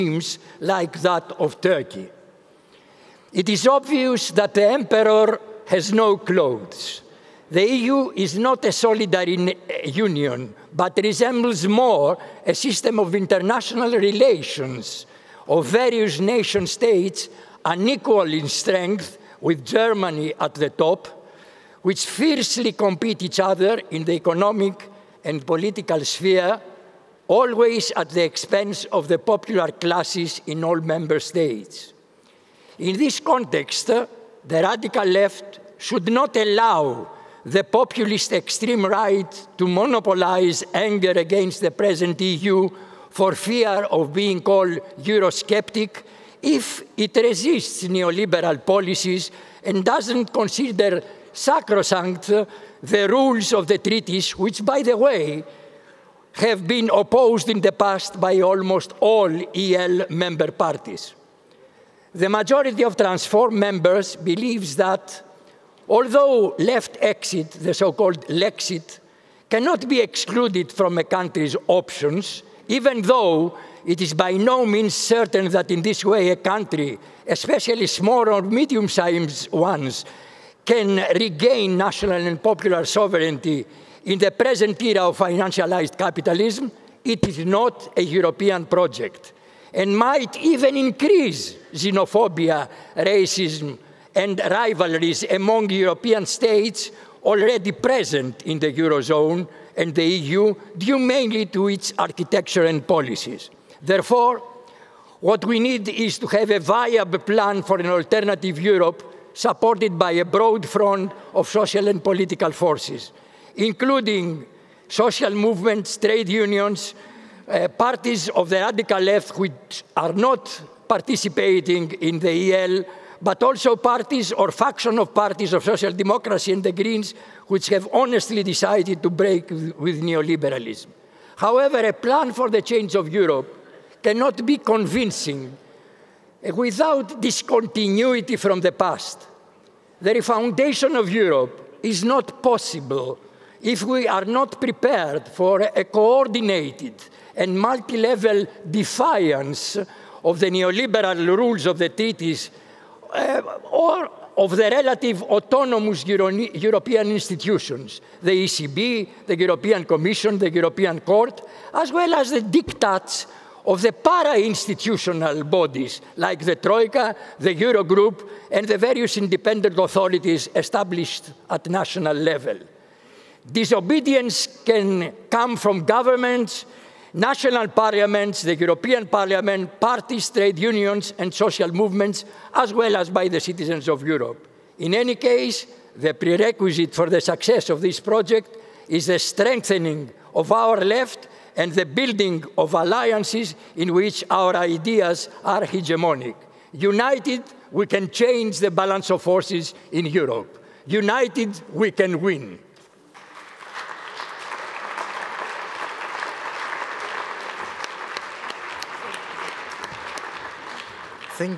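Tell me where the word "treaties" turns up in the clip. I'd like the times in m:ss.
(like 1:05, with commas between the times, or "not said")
0:53, 2:31.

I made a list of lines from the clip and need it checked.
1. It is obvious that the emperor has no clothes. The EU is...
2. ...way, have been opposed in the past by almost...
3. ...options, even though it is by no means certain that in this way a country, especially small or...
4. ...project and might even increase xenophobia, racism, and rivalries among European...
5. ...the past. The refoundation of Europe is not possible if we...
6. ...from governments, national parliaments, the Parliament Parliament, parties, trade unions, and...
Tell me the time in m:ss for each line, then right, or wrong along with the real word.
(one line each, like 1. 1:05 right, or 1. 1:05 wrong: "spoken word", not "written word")
1. 0:03 right
2. 0:54 right
3. 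1:11 right
4. 1:28 right
5. 2:18 right
6. 2:55 wrong: "European", not "Parliament".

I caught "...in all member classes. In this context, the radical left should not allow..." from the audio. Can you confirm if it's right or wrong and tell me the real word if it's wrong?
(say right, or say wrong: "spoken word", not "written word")
wrong: "states", not "classes".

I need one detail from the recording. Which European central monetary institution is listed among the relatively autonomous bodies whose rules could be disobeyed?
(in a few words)
ECB.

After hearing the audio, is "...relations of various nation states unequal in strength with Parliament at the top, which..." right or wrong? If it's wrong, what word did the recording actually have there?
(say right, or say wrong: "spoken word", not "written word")
wrong: "Germany", not "Parliament".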